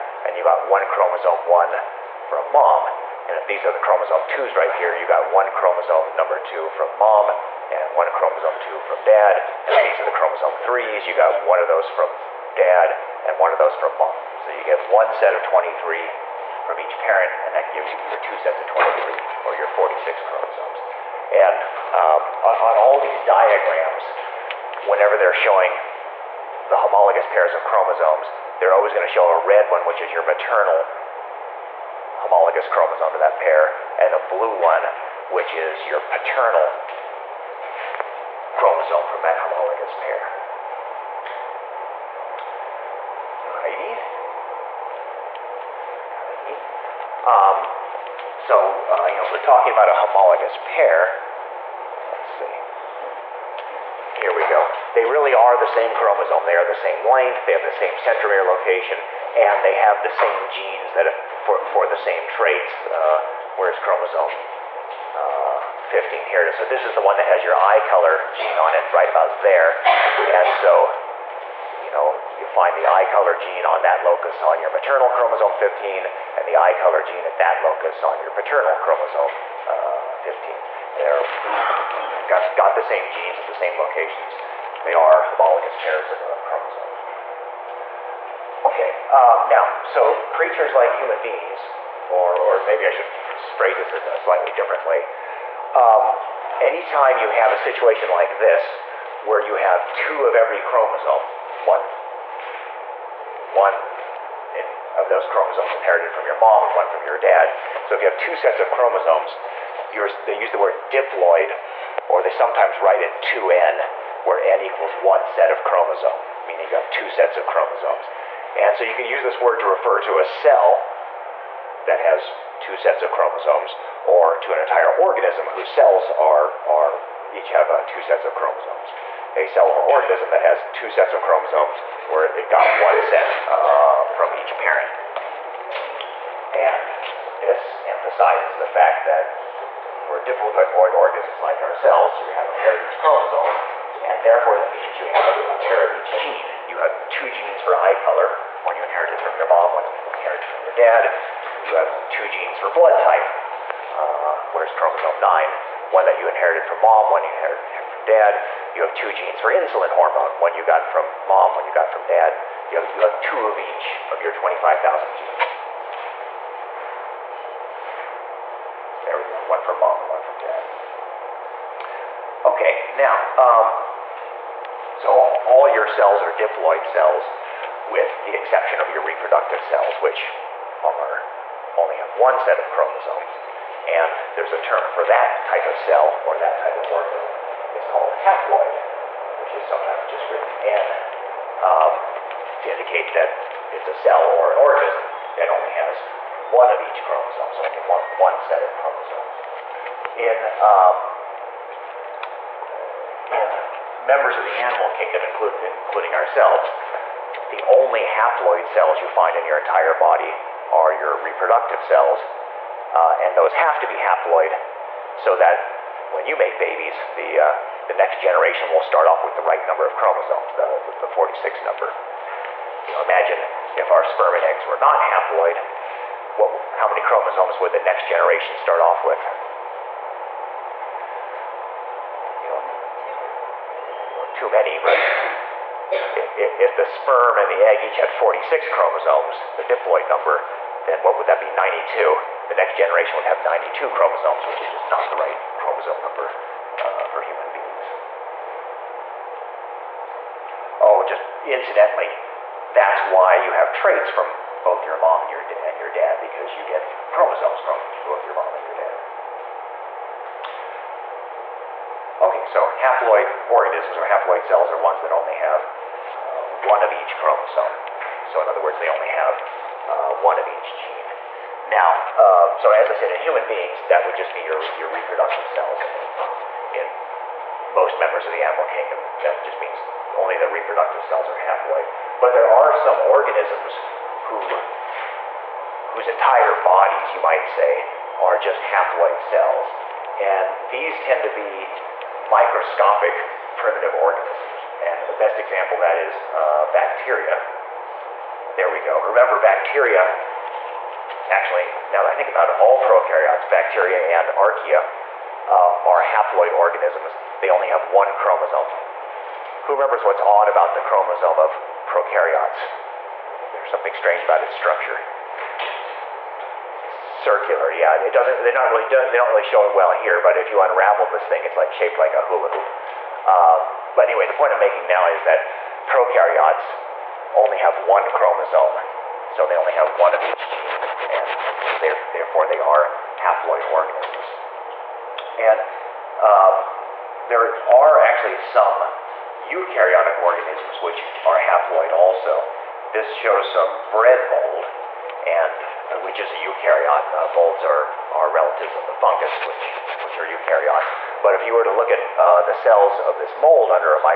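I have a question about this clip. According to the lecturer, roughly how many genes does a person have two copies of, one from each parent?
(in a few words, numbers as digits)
25,000.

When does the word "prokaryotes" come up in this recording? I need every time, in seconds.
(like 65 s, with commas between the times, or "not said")
302 s, 311 s, 325 s.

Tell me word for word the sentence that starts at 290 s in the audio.
And these tend to be microscopic primitive organisms.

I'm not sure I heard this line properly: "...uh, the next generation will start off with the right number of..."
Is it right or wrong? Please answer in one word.
right.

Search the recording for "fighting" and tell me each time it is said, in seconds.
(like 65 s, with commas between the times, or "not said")
not said.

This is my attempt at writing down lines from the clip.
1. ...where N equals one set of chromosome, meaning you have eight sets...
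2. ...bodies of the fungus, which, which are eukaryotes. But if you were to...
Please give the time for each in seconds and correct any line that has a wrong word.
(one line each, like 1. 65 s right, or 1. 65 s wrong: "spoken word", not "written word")
1. 114 s wrong: "two", not "eight"
2. 348 s wrong: "relatives", not "bodies".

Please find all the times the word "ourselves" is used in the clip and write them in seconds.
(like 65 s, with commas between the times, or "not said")
141 s, 206 s.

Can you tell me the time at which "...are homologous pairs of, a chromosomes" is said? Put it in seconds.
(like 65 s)
84 s.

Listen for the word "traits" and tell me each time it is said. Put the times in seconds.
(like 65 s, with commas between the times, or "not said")
62 s, 253 s.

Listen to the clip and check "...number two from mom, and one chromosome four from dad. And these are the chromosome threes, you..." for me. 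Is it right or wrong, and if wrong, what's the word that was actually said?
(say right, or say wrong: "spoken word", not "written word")
wrong: "two", not "four".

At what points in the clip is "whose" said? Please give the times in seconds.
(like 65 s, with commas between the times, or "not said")
125 s, 285 s.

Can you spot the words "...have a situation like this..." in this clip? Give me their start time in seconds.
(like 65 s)
97 s.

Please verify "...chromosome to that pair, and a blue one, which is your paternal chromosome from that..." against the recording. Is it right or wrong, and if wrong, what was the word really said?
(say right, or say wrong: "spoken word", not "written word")
right.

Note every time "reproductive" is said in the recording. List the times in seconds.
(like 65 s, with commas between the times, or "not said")
179 s, 211 s, 274 s, 280 s.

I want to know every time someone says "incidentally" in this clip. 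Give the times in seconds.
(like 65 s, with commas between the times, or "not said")
251 s.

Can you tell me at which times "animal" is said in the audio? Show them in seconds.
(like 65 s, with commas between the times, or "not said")
204 s, 278 s.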